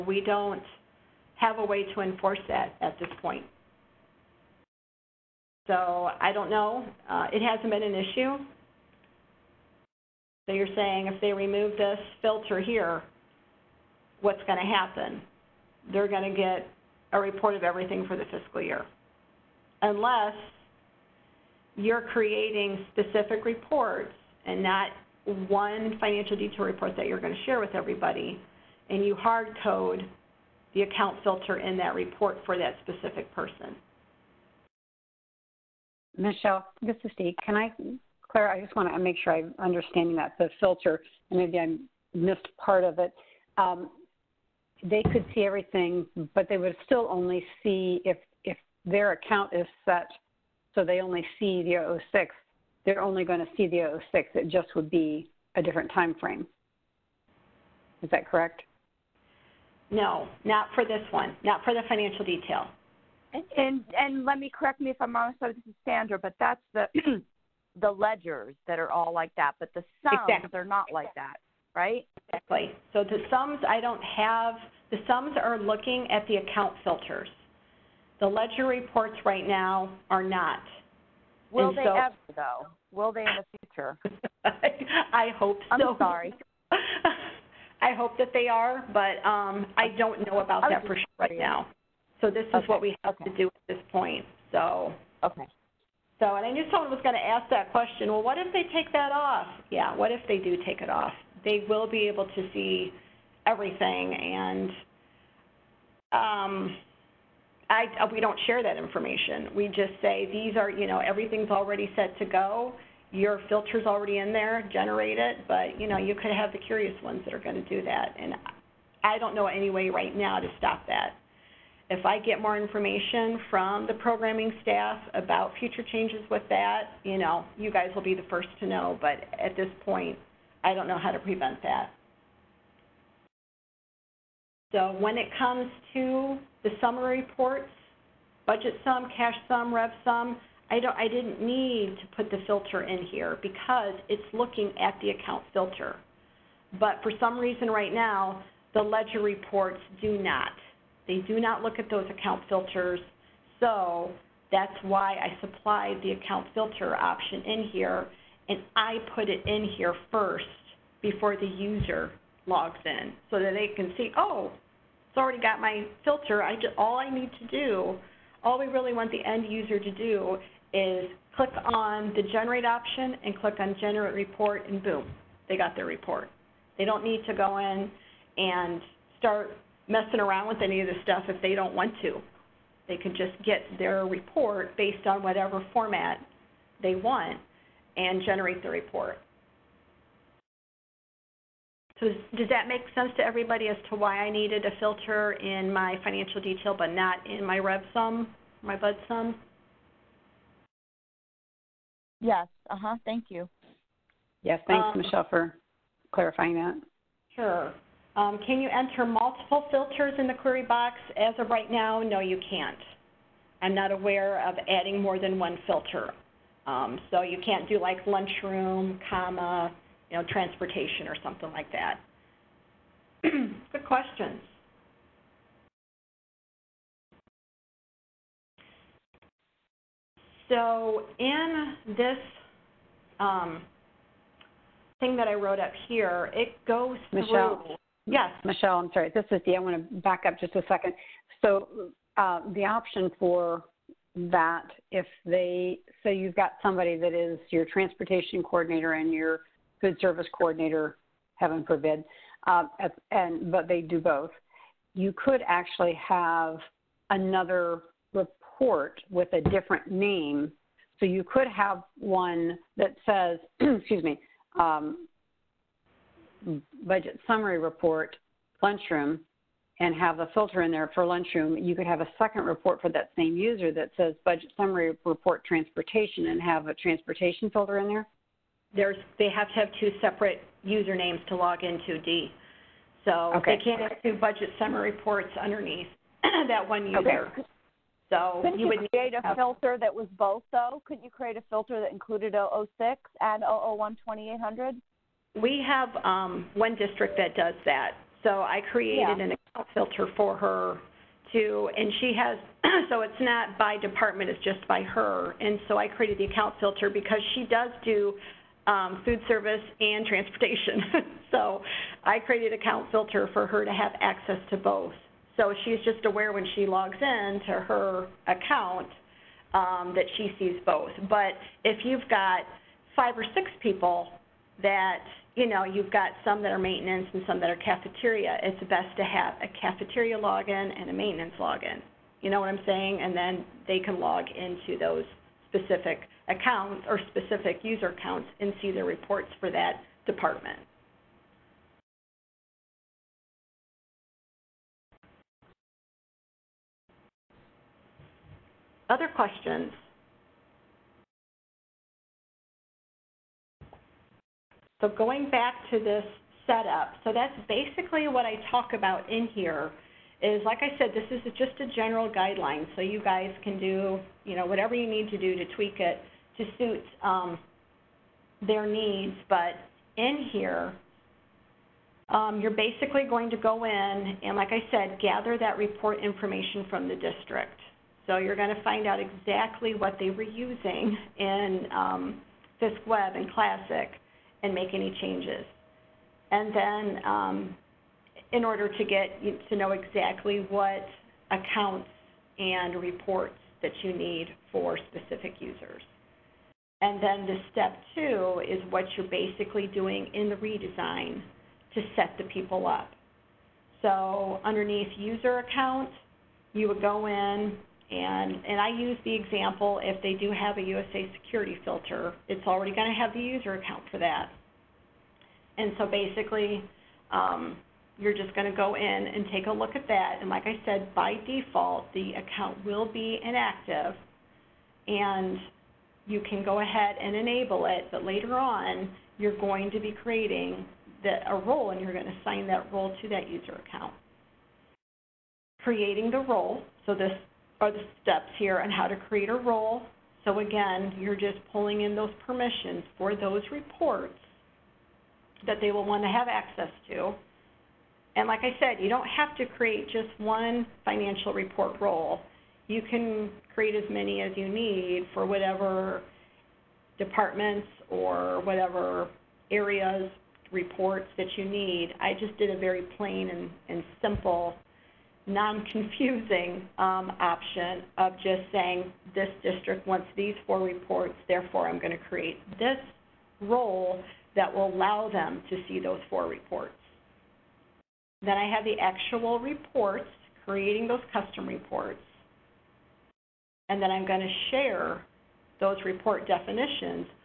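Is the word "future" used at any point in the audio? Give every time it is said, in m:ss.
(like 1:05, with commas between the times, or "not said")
1:23, 2:05.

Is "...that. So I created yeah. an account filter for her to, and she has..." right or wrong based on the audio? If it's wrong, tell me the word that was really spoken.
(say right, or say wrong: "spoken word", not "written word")
right.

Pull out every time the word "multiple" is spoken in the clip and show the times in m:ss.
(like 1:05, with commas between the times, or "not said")
3:29.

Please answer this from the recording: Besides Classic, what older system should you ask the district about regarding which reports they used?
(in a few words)
FISCWeb.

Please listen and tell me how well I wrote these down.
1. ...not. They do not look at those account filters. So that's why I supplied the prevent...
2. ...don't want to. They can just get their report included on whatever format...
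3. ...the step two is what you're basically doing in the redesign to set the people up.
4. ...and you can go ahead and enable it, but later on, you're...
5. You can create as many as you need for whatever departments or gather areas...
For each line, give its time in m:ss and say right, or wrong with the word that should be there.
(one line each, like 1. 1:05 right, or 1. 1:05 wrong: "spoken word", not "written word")
1. 2:30 wrong: "account", not "prevent"
2. 3:01 wrong: "based", not "included"
3. 6:37 right
4. 7:04 right
5. 7:32 wrong: "whatever", not "gather".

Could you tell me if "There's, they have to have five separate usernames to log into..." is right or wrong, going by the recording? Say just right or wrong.
wrong.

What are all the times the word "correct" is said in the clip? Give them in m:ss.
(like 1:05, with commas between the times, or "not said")
0:58, 1:04.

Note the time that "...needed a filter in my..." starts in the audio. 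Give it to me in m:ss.
3:14.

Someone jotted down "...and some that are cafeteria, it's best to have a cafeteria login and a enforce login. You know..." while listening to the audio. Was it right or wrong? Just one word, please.
wrong.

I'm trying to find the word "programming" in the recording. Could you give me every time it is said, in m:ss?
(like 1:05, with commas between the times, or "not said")
2:03.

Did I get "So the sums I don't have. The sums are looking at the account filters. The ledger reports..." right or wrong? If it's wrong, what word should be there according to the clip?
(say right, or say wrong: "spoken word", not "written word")
right.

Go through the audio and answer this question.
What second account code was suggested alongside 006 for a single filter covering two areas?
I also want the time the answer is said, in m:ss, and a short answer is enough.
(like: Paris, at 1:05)
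001 2800, at 4:53.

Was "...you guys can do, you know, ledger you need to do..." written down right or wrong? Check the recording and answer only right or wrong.
wrong.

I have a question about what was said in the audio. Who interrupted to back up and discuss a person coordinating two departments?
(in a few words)
Dee.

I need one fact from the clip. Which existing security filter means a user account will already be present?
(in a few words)
USAS.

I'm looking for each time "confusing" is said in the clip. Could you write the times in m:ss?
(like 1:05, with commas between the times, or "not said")
7:45.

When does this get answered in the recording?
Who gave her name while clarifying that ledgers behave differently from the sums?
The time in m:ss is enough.
1:05.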